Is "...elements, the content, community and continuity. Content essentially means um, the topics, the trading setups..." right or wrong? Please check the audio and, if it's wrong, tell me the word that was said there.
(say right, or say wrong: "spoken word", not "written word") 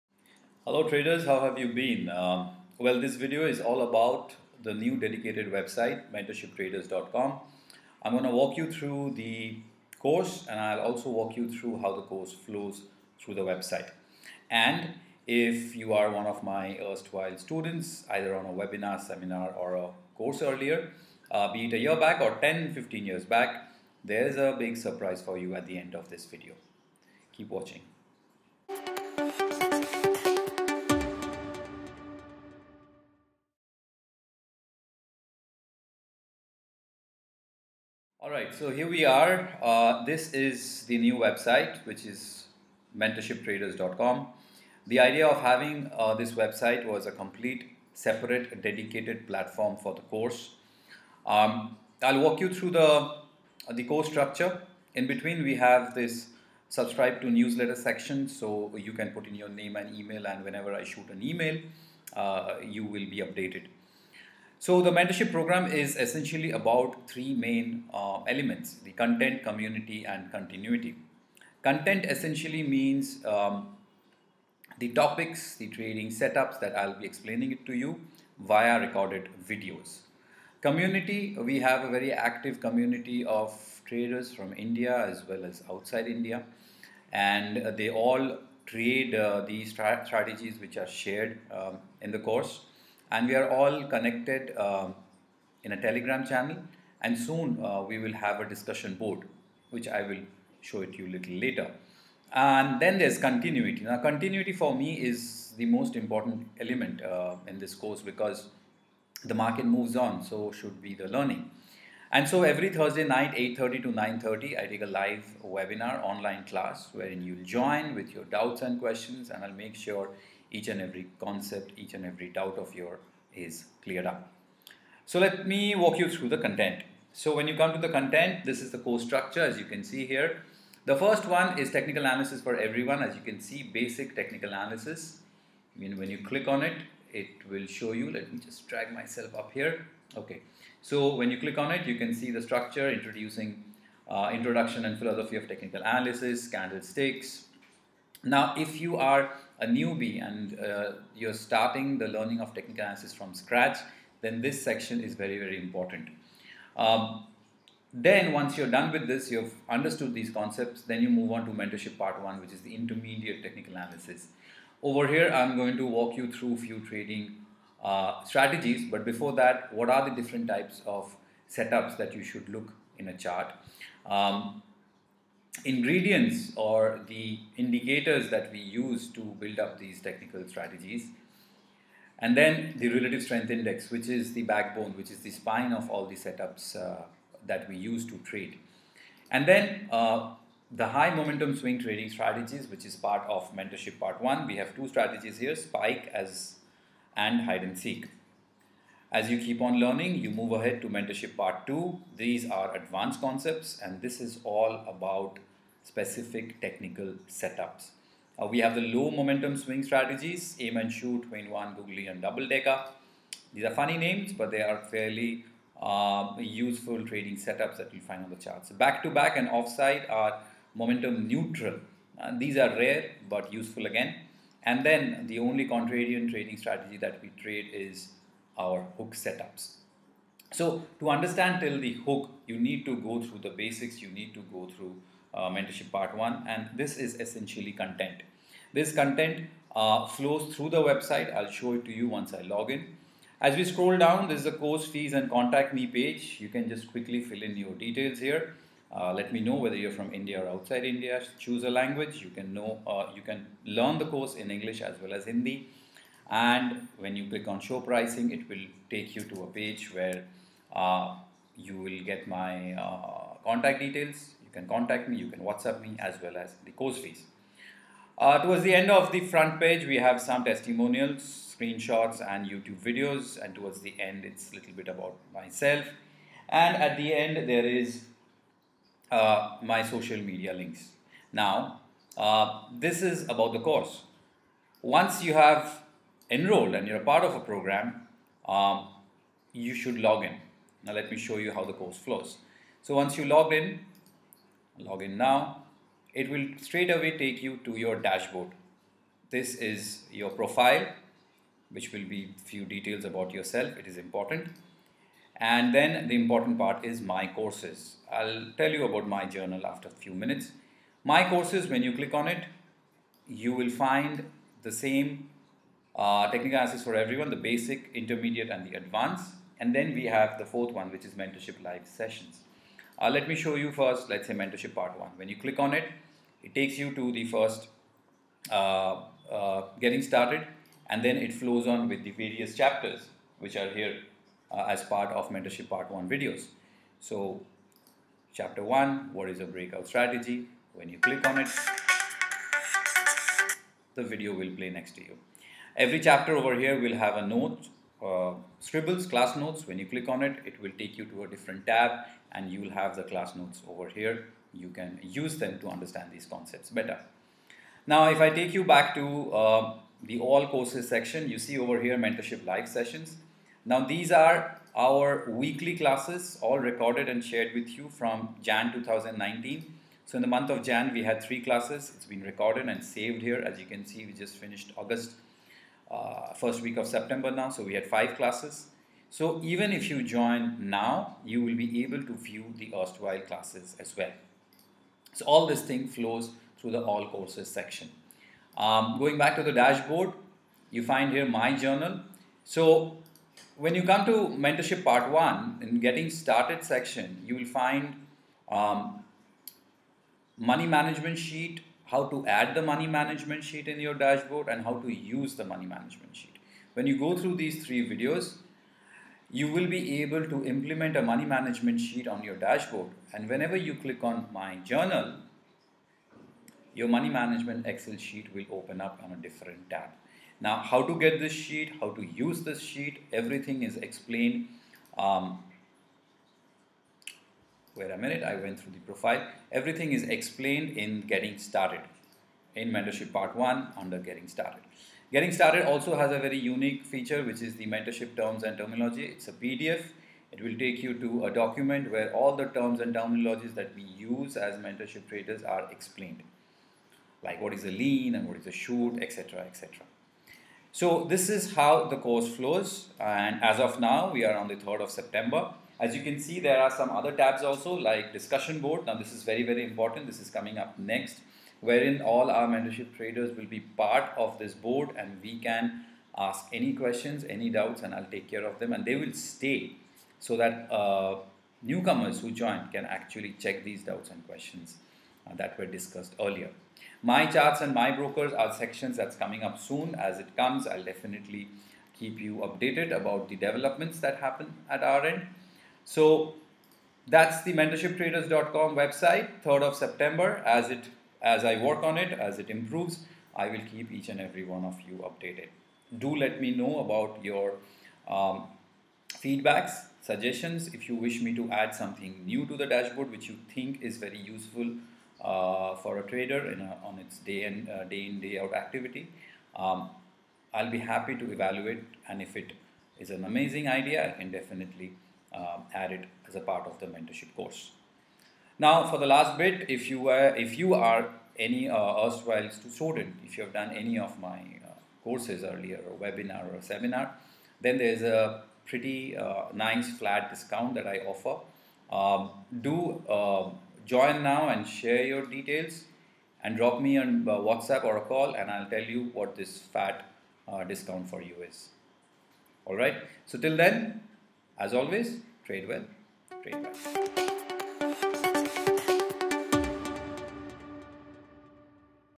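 right.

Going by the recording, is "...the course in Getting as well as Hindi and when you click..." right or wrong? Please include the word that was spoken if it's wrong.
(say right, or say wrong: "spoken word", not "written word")
wrong: "English", not "Getting".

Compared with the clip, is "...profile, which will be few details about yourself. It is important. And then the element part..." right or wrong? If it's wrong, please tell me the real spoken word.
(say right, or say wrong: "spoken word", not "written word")
wrong: "important", not "element".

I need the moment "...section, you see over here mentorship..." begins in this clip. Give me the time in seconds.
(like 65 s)
360 s.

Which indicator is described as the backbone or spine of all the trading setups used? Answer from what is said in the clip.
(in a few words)
Relative strength index.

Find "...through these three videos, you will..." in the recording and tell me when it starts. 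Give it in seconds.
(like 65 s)
407 s.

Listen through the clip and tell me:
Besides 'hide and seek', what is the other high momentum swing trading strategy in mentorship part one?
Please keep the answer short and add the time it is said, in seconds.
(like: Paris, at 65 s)
Spike, at 195 s.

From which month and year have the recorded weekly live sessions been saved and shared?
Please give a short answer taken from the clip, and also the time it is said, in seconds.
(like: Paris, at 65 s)
Jan 2019, at 368 s.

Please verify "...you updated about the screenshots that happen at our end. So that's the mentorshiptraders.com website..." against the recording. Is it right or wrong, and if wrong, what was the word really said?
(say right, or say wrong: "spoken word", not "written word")
wrong: "developments", not "screenshots".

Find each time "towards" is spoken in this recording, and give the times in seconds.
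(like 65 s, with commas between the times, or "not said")
268 s, 273 s.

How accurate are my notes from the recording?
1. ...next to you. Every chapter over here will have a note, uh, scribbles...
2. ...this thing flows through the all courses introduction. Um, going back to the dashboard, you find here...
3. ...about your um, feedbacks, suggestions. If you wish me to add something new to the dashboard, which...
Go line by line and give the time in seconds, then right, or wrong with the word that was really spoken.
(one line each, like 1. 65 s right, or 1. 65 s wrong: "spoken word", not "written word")
1. 344 s right
2. 385 s wrong: "section", not "introduction"
3. 496 s right.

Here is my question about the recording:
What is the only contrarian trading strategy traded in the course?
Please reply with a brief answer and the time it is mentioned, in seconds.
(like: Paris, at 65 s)
Hook setups, at 228 s.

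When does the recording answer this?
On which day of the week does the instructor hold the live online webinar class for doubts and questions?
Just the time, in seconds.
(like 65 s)
112 s.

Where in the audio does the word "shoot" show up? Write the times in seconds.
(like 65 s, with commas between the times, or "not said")
60 s, 210 s, 448 s.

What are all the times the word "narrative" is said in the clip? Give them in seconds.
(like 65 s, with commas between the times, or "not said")
not said.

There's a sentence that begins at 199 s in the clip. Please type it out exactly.
As you keep on learning, you move ahead to mentorship part two.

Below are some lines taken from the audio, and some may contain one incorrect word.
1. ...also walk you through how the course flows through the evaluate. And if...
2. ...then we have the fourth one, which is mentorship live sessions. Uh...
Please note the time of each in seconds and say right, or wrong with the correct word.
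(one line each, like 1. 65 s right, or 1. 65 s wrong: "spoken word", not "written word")
1. 10 s wrong: "website", not "evaluate"
2. 319 s right.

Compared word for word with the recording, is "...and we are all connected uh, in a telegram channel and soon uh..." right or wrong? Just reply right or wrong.
right.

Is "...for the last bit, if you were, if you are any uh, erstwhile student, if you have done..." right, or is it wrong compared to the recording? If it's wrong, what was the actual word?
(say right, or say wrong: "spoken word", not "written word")
right.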